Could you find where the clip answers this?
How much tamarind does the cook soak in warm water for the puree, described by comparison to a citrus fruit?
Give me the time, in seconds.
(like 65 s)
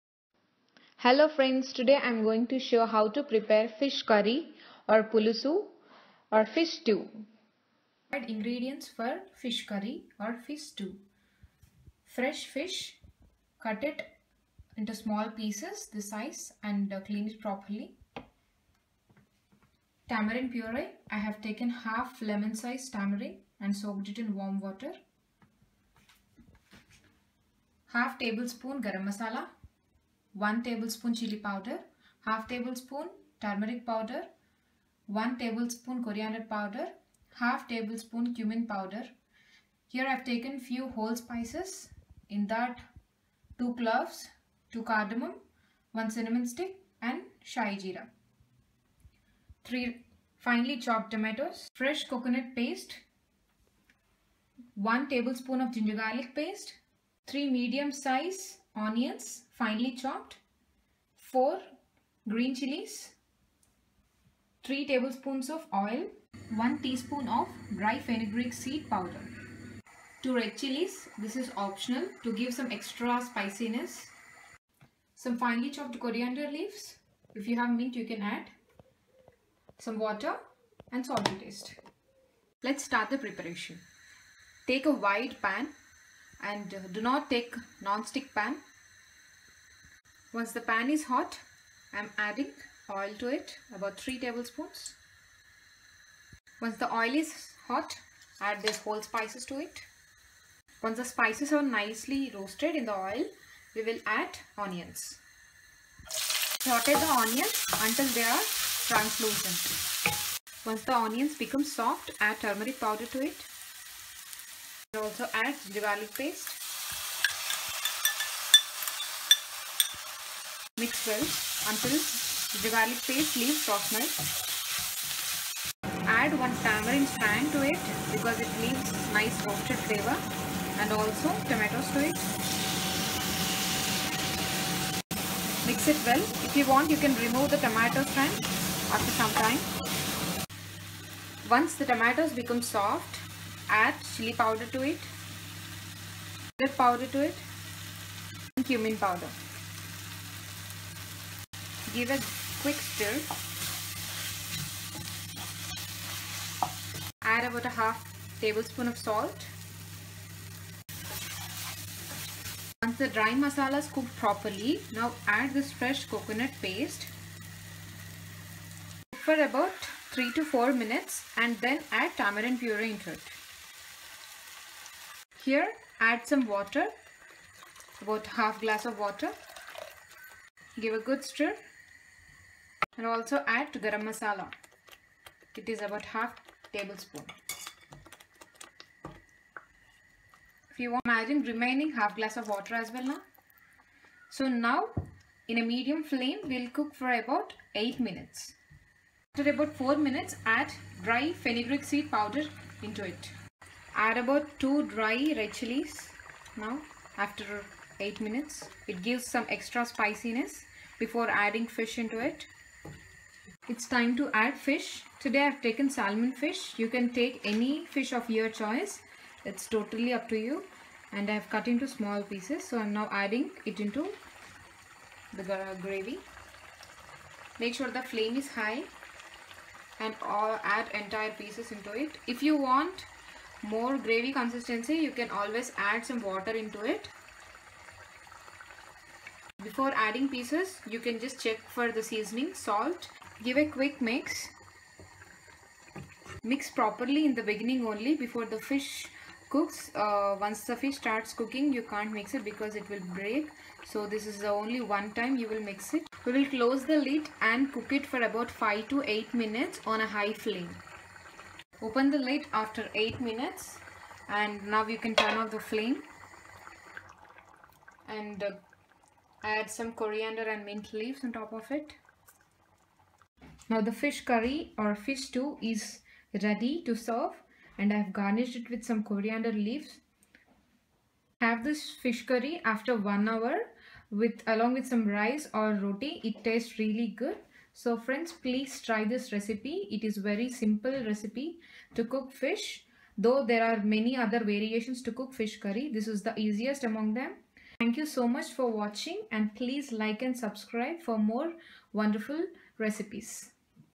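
21 s.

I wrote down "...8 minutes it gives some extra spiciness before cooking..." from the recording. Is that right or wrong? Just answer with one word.
wrong.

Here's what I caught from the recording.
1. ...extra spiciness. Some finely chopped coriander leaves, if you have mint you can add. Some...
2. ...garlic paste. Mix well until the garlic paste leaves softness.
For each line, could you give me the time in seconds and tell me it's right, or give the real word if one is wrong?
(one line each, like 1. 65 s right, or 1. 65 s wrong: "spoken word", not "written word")
1. 72 s right
2. 115 s right.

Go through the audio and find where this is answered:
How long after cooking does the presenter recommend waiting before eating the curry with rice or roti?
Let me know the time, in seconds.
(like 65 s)
282 s.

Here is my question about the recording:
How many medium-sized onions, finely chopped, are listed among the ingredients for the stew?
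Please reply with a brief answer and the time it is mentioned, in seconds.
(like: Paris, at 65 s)
3, at 57 s.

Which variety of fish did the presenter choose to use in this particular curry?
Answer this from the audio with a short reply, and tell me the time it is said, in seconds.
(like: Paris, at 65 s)
salmon, at 215 s.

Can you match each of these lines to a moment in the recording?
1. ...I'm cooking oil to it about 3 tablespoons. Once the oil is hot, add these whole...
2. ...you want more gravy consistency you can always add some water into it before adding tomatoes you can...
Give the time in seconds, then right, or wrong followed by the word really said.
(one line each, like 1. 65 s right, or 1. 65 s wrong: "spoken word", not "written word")
1. 91 s wrong: "adding", not "cooking"
2. 232 s wrong: "pieces", not "tomatoes".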